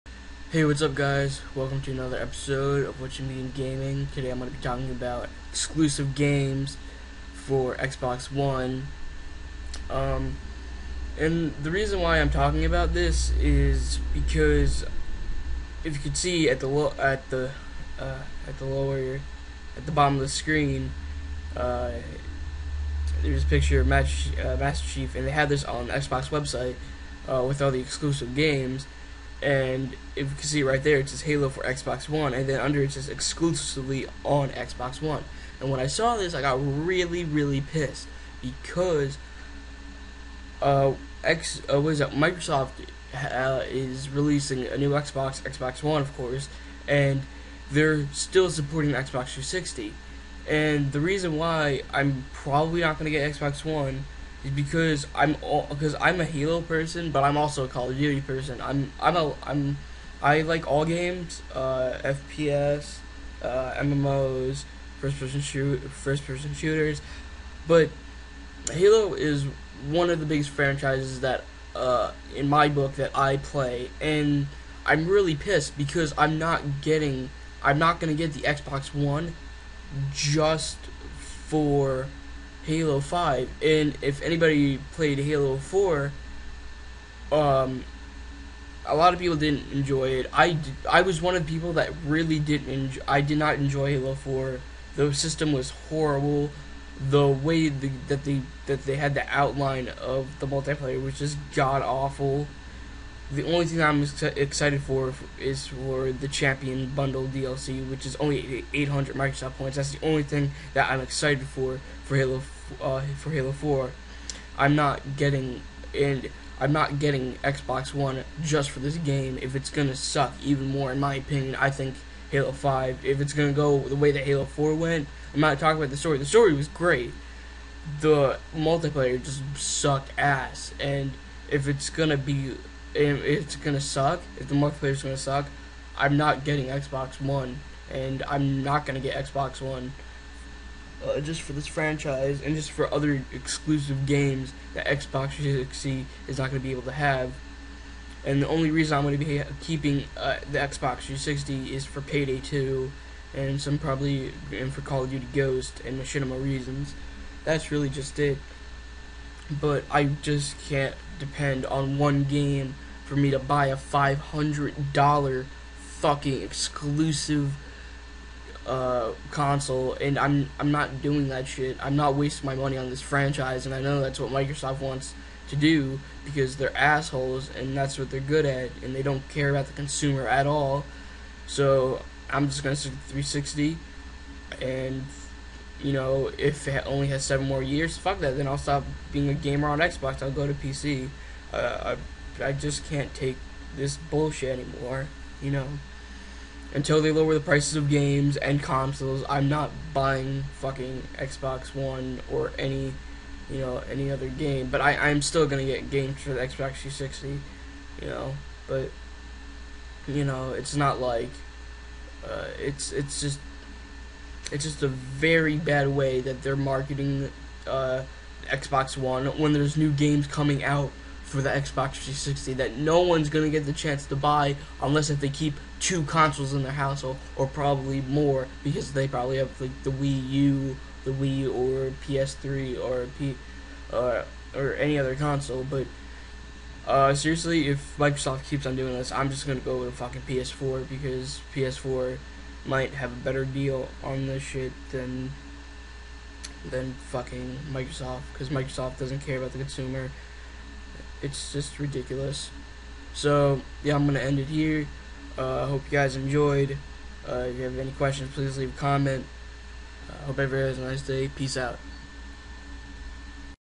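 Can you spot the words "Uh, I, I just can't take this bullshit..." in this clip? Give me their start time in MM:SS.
03:11.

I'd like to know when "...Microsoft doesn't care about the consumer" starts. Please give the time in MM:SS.
04:08.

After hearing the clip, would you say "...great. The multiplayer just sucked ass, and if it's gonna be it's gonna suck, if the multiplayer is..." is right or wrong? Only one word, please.
right.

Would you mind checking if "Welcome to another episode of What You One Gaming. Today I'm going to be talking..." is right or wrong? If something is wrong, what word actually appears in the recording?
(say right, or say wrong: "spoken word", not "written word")
wrong: "Mean", not "One".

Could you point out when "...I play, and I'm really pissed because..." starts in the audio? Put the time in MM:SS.
01:13.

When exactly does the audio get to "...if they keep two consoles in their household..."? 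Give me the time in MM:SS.
03:45.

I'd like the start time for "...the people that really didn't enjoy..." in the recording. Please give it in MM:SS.
01:31.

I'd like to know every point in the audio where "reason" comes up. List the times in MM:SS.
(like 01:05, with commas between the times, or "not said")
00:11, 00:50, 02:28, 02:36.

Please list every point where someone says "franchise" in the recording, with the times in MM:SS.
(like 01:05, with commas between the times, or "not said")
01:10, 02:21, 02:53.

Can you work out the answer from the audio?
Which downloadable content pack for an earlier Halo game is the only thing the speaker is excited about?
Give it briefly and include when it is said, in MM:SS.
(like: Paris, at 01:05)
Champion Bundle, at 01:46.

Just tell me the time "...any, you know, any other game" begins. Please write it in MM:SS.
03:22.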